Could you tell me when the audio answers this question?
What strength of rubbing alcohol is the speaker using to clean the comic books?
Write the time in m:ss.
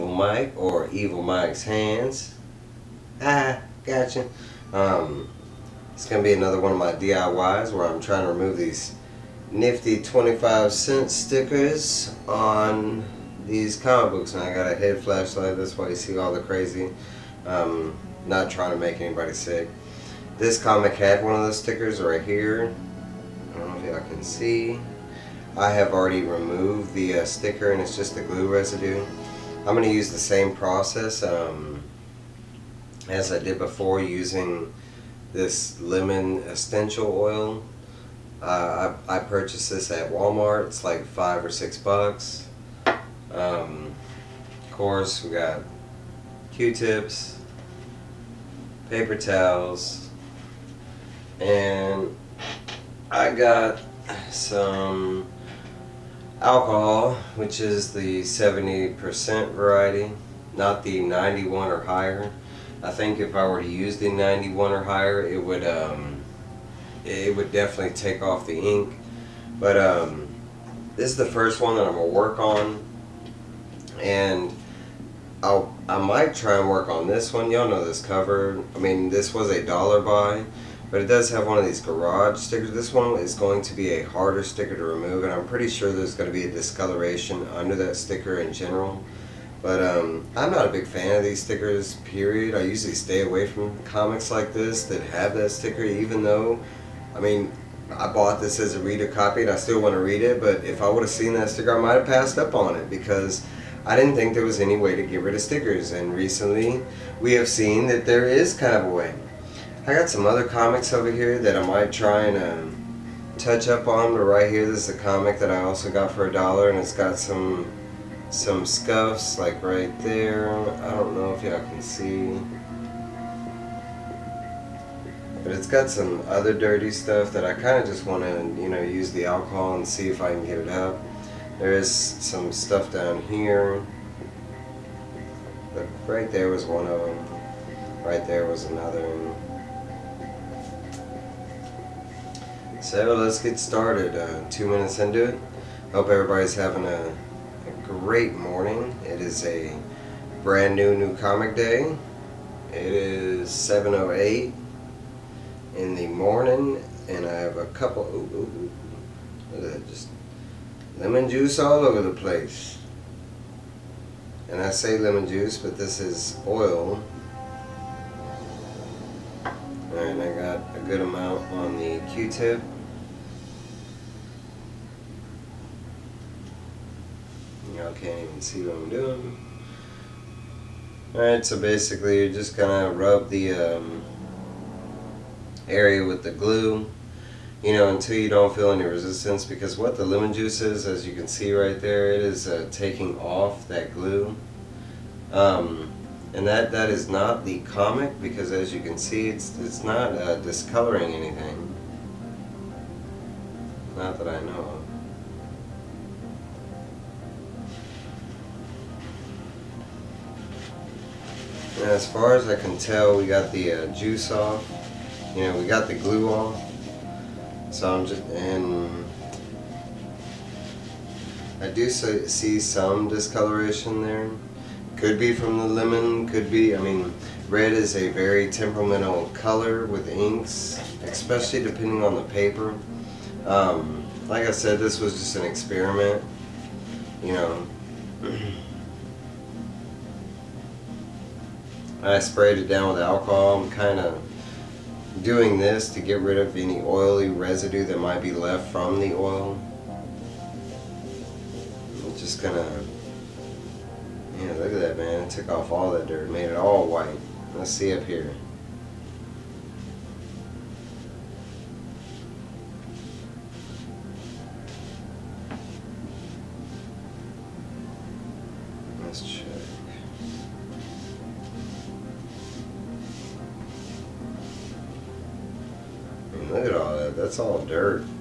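0:58.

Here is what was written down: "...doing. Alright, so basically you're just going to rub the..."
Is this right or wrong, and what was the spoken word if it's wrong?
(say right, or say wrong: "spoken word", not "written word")
right.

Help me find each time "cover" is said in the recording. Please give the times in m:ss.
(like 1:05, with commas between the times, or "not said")
1:18.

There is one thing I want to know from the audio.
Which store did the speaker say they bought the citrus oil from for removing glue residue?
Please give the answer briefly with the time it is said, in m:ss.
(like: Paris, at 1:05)
Walmart, at 0:40.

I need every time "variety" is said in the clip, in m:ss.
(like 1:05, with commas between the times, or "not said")
0:59.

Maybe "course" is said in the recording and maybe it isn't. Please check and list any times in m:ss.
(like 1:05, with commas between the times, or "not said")
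0:44.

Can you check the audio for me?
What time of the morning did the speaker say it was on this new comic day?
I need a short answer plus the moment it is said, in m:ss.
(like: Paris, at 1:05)
7:08, at 2:33.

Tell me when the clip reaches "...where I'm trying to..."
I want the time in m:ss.
0:07.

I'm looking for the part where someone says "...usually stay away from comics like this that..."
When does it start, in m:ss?
1:32.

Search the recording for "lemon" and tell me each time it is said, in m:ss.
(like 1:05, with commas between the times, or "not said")
0:35, 2:40, 2:44, 3:10, 3:45.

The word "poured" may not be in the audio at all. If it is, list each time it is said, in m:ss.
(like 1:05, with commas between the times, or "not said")
not said.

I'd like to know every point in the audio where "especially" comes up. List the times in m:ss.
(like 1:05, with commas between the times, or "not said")
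3:51.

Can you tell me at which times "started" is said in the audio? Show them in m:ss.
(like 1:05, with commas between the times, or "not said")
2:23.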